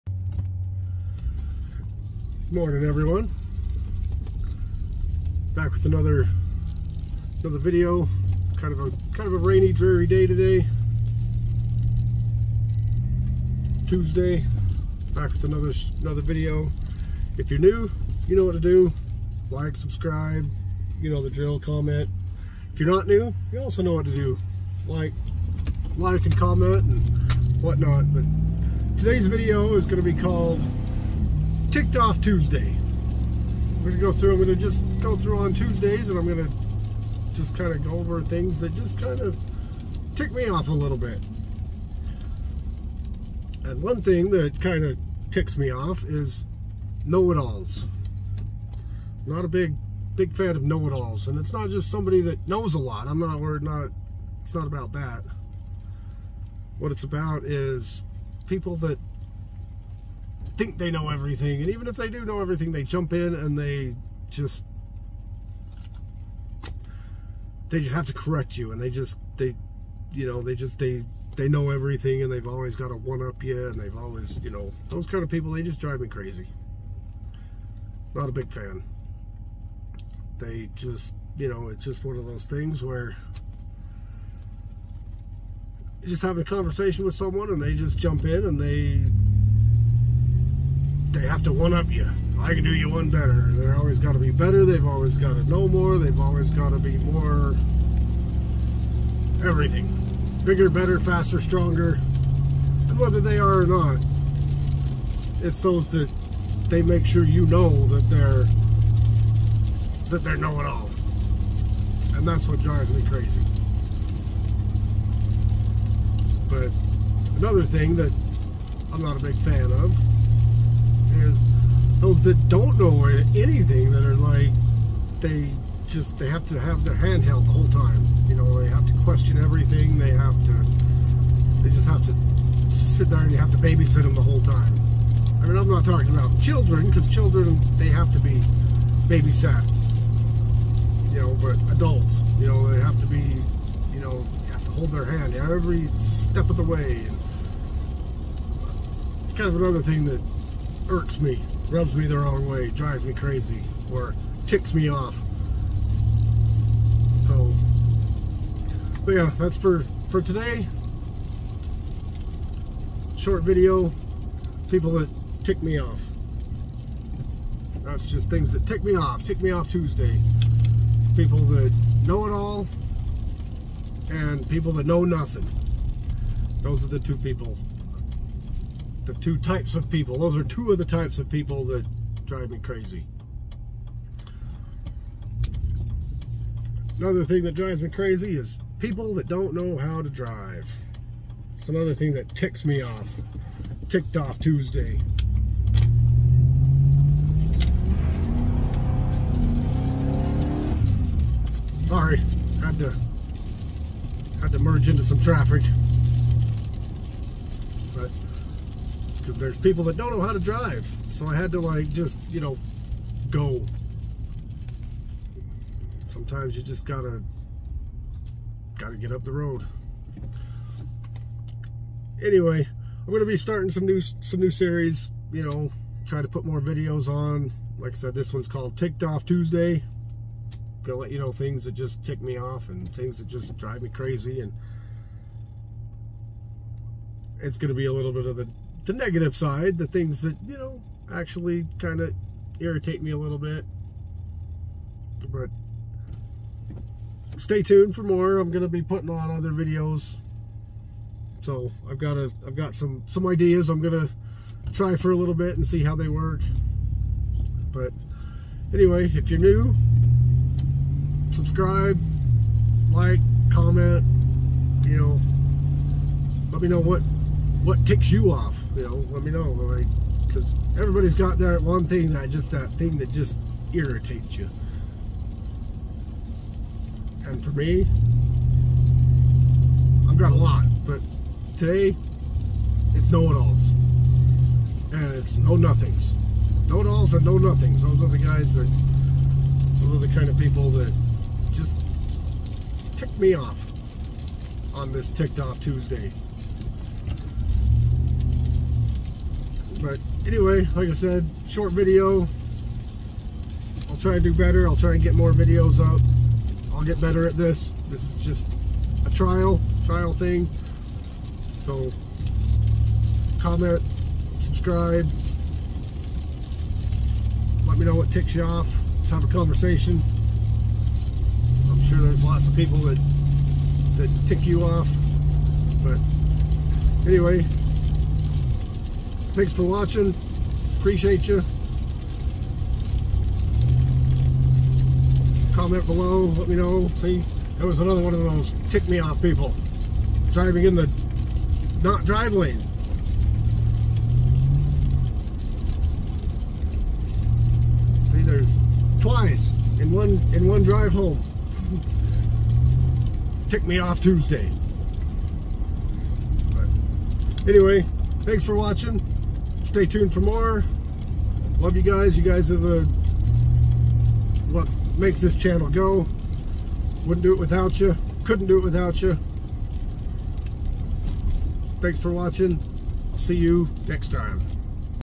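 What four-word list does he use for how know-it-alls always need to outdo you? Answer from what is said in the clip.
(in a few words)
Bigger, better, faster, stronger.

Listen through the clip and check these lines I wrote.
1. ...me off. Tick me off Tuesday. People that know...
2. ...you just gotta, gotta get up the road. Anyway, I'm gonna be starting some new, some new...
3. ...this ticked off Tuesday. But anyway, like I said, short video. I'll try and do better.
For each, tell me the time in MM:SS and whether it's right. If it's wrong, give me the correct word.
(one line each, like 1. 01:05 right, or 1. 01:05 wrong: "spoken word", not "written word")
1. 02:48 right
2. 03:36 right
3. 04:54 right.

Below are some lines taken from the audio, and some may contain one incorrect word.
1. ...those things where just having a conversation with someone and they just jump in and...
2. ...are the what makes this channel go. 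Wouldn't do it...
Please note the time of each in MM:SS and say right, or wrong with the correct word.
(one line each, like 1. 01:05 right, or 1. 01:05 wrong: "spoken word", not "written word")
1. 01:22 right
2. 06:02 right.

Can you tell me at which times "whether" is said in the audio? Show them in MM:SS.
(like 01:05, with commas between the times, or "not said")
01:42.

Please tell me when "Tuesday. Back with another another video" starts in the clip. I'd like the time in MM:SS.
00:13.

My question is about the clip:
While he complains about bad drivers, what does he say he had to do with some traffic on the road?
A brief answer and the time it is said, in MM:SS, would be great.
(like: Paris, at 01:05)
merge, at 03:24.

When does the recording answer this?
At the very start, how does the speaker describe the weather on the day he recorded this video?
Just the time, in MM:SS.
00:09.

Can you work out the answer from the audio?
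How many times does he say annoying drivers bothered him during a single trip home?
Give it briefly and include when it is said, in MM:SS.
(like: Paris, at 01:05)
twice, at 05:48.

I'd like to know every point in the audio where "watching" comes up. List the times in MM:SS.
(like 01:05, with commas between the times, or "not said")
05:29, 05:58, 06:12.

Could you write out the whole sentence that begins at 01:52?
And that's what drives me crazy.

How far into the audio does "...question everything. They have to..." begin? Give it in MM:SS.
02:09.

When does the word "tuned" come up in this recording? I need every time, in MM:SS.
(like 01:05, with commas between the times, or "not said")
04:07, 05:59.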